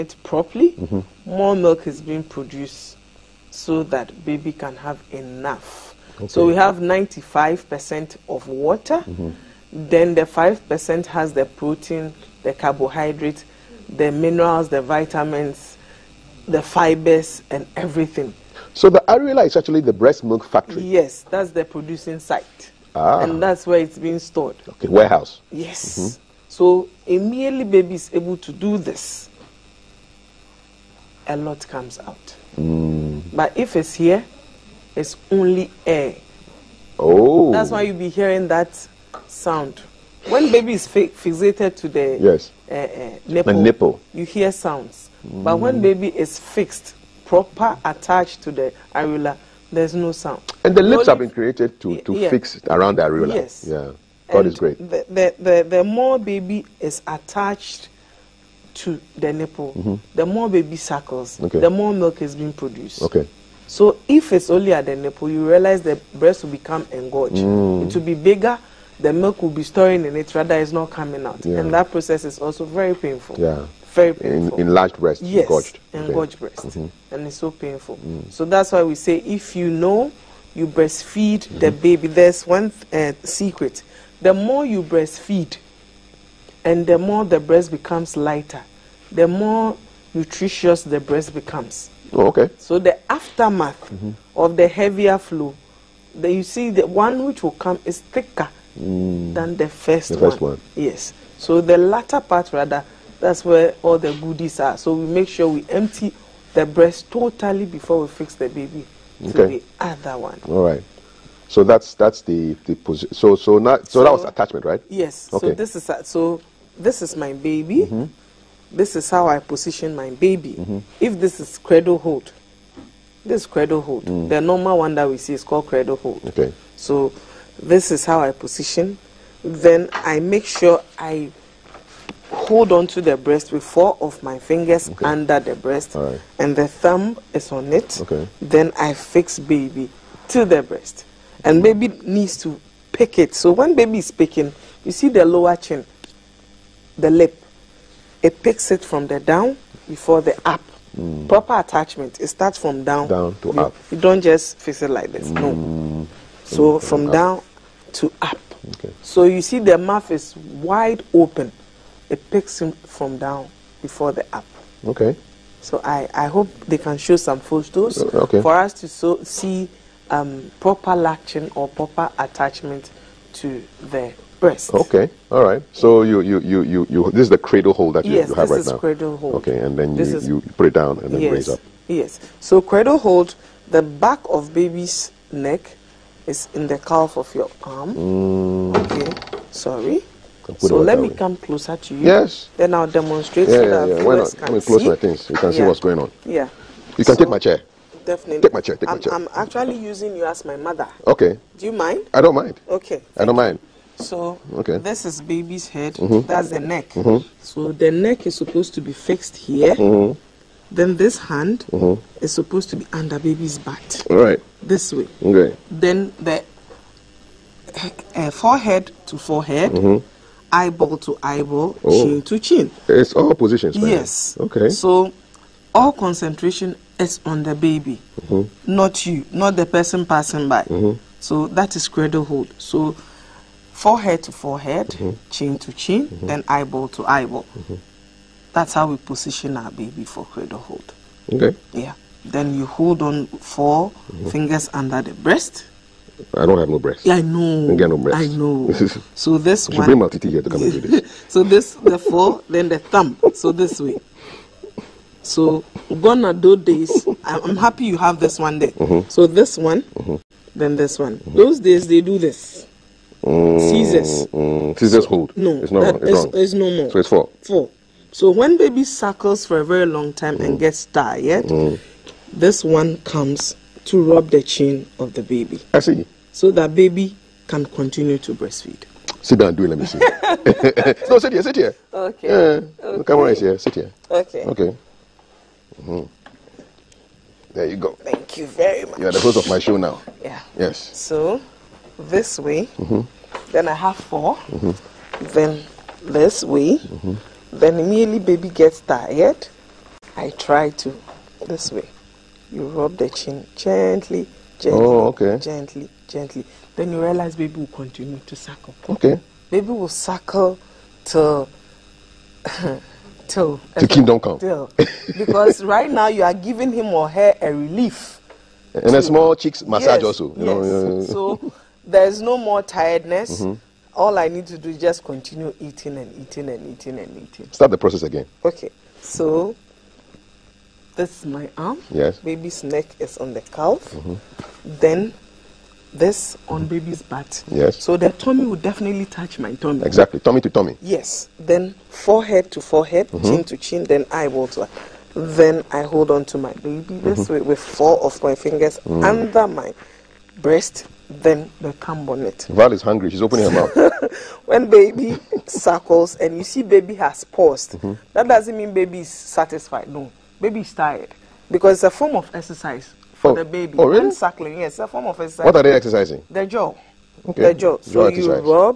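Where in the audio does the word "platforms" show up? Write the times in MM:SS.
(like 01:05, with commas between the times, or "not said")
not said.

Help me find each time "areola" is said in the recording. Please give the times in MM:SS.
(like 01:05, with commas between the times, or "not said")
00:19, 00:48, 00:53.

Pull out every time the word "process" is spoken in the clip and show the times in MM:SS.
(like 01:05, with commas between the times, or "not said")
01:11, 05:27.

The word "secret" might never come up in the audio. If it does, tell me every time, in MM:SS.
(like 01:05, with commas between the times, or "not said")
01:23.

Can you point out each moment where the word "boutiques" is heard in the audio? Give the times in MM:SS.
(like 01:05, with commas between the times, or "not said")
not said.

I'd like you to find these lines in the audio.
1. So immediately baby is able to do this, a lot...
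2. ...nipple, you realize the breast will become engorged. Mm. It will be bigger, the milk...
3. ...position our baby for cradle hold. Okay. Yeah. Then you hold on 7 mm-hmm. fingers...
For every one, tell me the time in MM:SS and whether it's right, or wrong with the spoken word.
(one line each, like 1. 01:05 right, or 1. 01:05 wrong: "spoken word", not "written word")
1. 00:26 right
2. 01:04 right
3. 03:58 wrong: "4", not "7".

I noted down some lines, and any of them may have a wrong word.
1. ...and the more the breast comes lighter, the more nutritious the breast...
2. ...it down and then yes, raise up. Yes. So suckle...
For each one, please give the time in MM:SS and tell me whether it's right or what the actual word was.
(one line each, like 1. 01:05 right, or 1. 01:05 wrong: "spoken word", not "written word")
1. 01:26 wrong: "becomes", not "comes"
2. 03:00 wrong: "cradle", not "suckle".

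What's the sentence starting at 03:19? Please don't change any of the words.
I'm actually using you as my mother.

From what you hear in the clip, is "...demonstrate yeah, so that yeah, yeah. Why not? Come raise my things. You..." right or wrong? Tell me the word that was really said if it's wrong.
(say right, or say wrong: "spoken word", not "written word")
wrong: "close", not "raise".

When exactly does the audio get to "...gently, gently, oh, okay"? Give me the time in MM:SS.
05:03.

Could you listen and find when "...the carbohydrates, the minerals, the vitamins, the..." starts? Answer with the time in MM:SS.
00:12.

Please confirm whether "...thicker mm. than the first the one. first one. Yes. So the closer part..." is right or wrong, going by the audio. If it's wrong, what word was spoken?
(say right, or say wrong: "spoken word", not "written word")
wrong: "latter", not "closer".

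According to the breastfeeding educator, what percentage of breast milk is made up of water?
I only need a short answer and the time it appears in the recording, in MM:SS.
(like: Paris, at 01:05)
95%, at 00:06.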